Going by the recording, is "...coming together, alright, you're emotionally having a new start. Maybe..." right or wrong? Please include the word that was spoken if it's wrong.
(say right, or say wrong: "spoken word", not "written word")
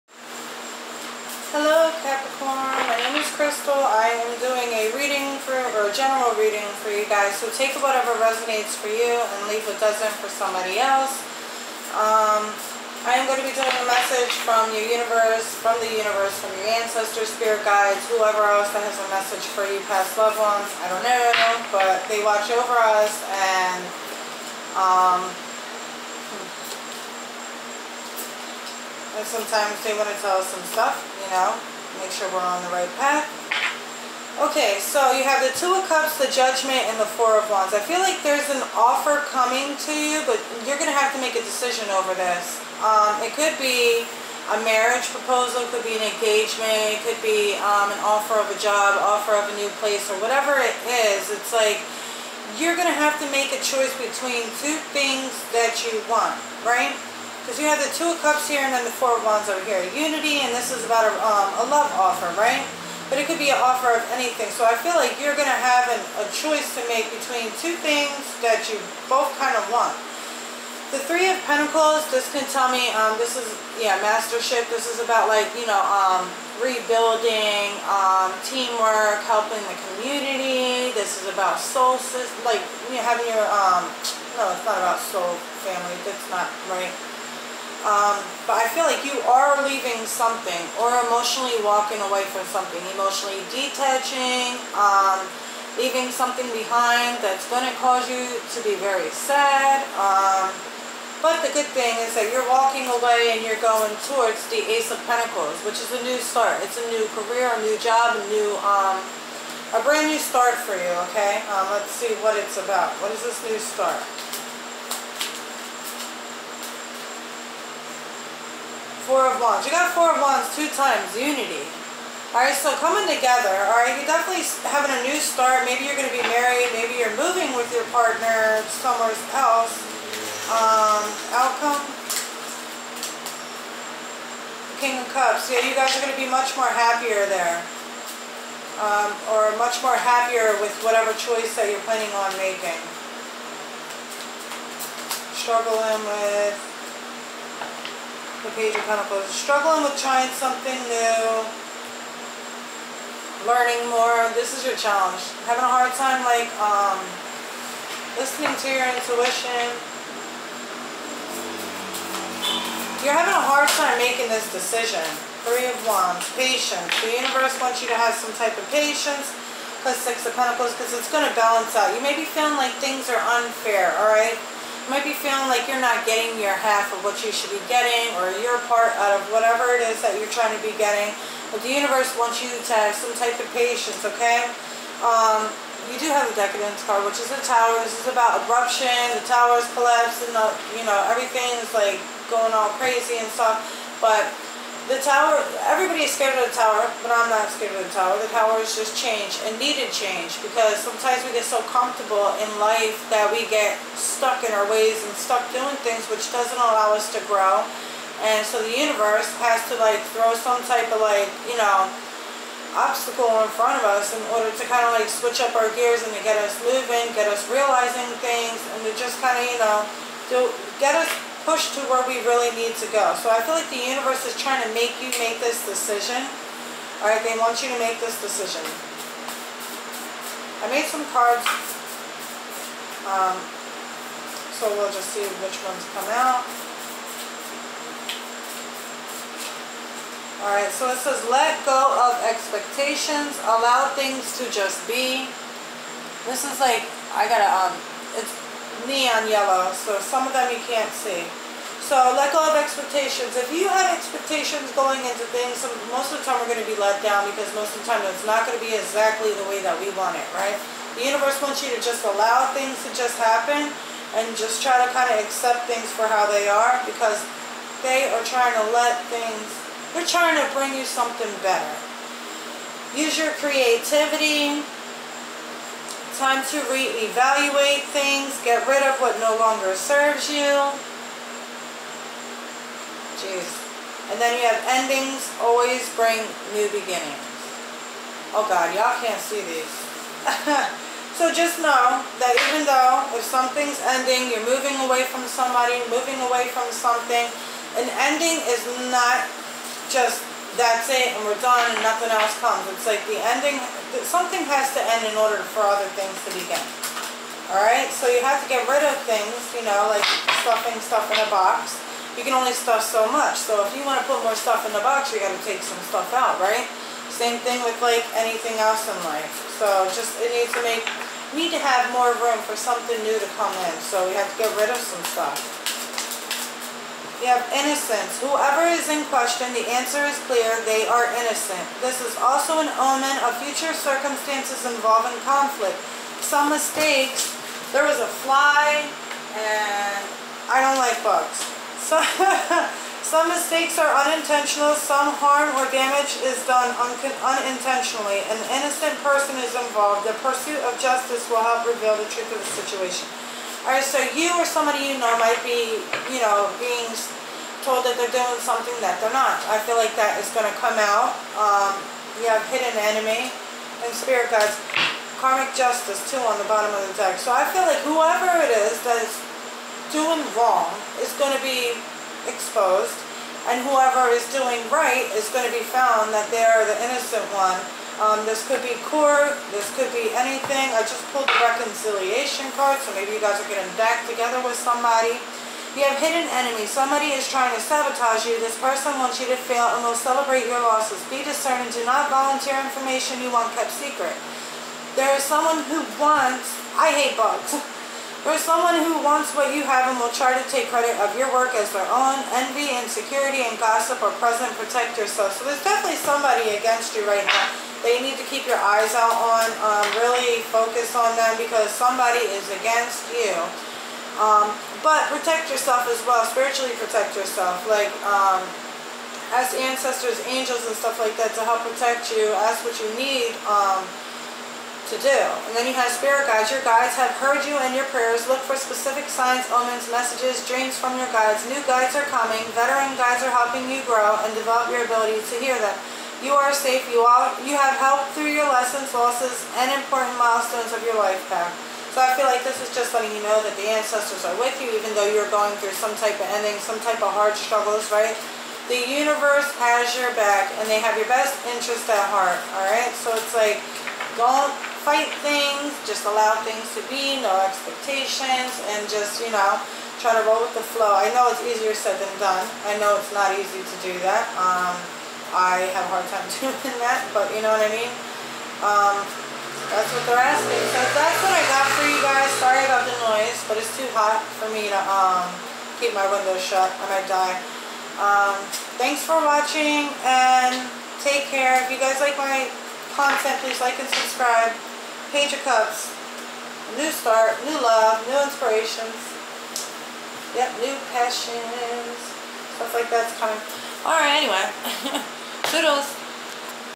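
wrong: "definitely", not "emotionally".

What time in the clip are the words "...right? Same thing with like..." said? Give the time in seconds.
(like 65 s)
316 s.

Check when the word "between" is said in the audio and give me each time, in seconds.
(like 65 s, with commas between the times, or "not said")
53 s, 67 s.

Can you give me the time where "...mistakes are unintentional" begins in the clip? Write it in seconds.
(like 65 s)
343 s.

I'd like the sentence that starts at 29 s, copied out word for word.
and sometimes they want to tell us some stuff now.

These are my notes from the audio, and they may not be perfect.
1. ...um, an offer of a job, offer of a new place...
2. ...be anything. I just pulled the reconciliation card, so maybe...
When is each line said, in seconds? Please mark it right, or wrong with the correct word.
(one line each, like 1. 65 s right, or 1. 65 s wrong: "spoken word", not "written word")
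1. 47 s right
2. 379 s right.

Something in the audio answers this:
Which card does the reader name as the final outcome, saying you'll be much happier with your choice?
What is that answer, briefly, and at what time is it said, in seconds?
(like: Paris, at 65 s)
King of Cups, at 134 s.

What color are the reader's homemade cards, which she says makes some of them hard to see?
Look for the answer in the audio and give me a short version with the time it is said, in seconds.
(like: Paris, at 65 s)
Neon yellow, at 248 s.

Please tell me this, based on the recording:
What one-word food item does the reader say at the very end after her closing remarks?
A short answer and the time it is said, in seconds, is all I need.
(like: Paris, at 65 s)
Churros, at 495 s.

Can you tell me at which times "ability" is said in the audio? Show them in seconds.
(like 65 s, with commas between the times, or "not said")
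434 s.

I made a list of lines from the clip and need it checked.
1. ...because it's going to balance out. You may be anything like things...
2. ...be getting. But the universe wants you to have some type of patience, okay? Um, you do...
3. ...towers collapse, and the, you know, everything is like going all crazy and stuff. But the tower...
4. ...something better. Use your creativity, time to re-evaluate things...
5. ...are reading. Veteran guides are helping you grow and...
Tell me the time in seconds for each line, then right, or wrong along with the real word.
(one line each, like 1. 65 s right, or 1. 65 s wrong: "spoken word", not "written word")
1. 170 s wrong: "feeling", not "anything"
2. 180 s right
3. 189 s right
4. 270 s right
5. 431 s wrong: "coming", not "reading".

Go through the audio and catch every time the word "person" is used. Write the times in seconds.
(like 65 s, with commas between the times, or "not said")
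349 s, 388 s.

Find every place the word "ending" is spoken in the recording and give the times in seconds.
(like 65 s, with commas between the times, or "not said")
284 s, 293 s, 297 s, 303 s, 446 s.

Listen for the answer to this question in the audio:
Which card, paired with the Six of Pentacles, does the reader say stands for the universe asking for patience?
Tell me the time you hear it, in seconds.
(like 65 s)
165 s.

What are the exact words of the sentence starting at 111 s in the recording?
Um, let's see what it's about.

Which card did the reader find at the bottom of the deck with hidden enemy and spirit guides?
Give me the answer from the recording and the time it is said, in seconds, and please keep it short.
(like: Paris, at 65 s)
Karmic justice, at 365 s.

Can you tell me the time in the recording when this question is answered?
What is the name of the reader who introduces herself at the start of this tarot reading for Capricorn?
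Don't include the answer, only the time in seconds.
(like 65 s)
3 s.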